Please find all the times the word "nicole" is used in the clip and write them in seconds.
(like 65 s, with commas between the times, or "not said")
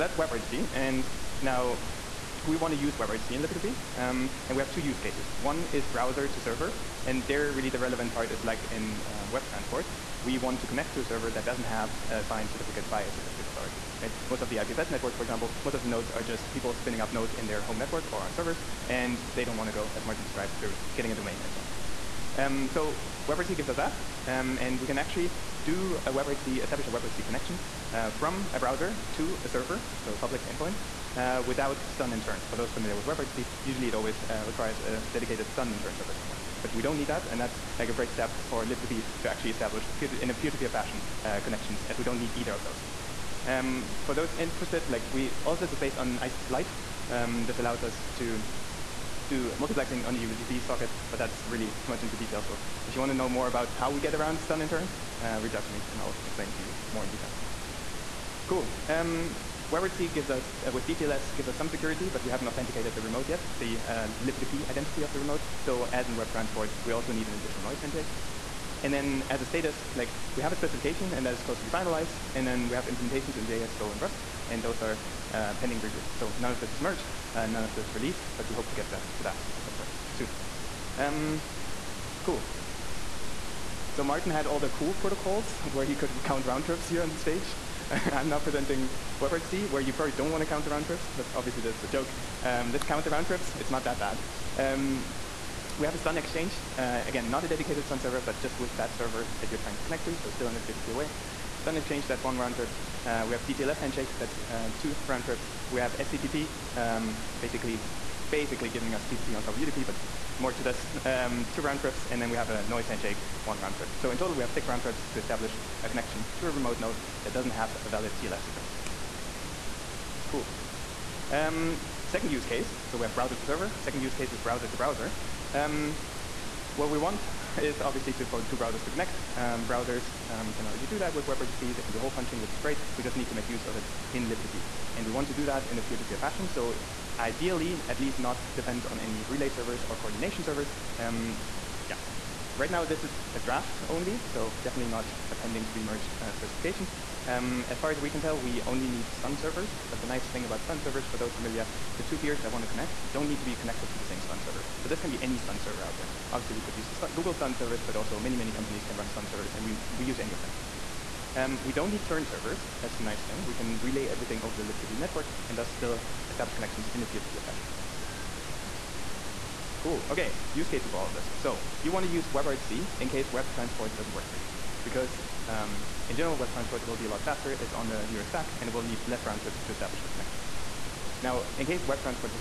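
not said.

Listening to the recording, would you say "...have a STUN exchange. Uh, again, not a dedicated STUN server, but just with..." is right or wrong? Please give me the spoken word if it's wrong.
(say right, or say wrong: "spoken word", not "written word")
right.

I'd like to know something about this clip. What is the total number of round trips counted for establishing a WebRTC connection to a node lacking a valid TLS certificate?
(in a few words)
6.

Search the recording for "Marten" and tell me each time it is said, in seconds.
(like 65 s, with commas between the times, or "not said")
20 s, 84 s.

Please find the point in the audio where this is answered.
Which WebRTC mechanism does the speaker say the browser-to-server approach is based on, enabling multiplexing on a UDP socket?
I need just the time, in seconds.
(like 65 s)
46 s.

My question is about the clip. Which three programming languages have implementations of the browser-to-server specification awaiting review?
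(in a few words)
JS, Go, and Rust.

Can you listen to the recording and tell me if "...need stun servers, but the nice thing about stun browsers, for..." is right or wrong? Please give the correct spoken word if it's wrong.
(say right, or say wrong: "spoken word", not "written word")
wrong: "servers", not "browsers".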